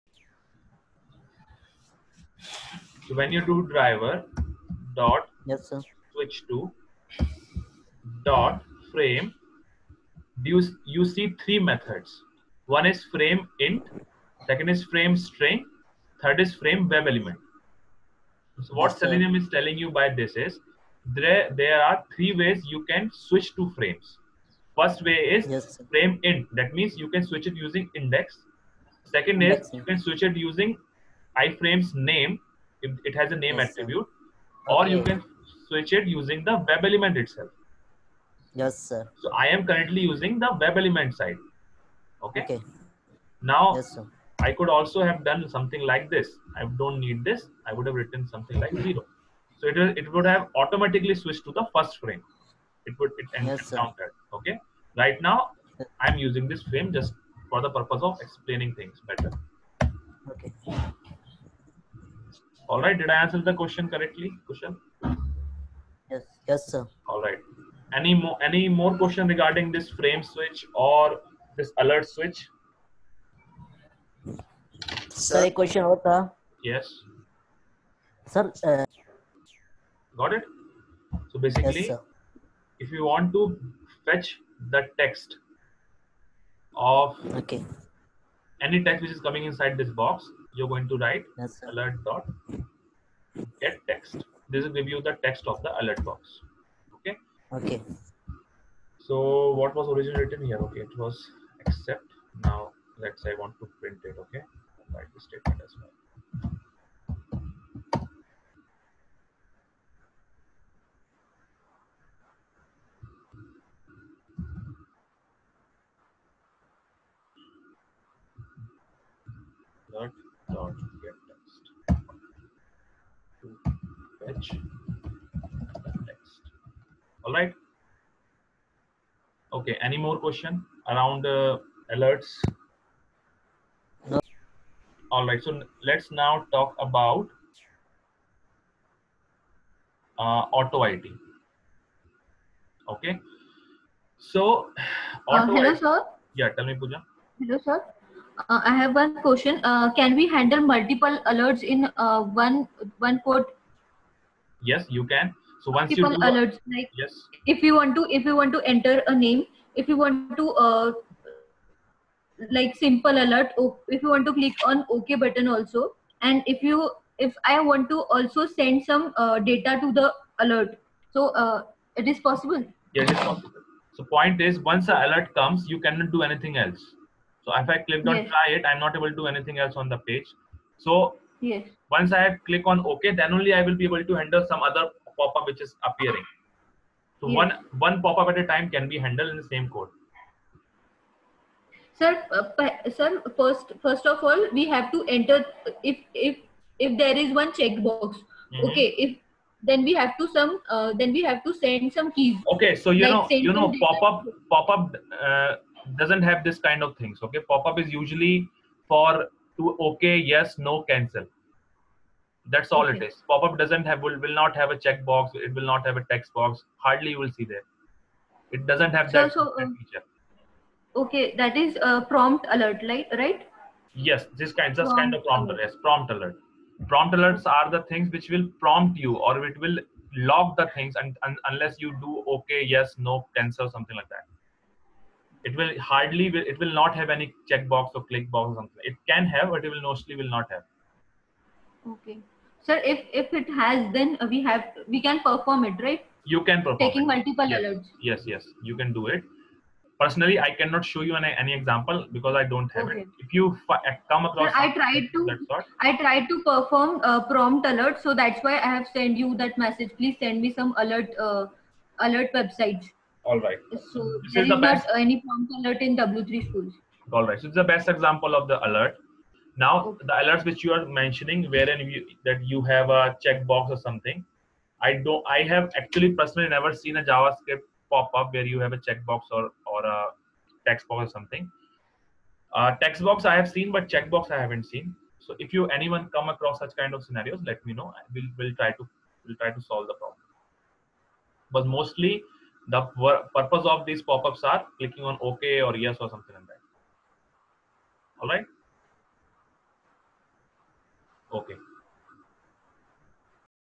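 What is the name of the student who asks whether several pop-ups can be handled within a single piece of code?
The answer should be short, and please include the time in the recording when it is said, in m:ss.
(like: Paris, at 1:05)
Puja, at 2:26.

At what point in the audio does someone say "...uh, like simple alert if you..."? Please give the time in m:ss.
2:40.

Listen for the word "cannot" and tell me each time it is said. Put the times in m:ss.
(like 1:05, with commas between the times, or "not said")
2:55, 4:10.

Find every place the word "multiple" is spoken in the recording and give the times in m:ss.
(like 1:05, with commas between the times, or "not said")
2:30, 4:07.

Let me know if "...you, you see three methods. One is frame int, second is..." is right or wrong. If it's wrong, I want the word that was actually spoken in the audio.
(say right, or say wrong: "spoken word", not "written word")
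right.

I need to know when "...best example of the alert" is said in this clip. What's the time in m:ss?
4:27.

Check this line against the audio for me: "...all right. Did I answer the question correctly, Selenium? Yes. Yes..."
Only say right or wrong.
wrong.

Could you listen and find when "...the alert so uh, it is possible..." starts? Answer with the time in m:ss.
2:49.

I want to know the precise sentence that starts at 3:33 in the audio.
Pop-up doesn't have will, will not have a checkbox.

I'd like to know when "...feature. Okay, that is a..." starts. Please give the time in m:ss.
3:39.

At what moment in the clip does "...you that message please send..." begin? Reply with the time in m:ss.
4:19.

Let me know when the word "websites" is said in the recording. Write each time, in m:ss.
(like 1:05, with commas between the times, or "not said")
4:22.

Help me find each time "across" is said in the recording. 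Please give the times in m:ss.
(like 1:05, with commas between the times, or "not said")
4:14, 4:46.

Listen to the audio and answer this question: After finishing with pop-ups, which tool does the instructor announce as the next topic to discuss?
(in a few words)
AutoIt.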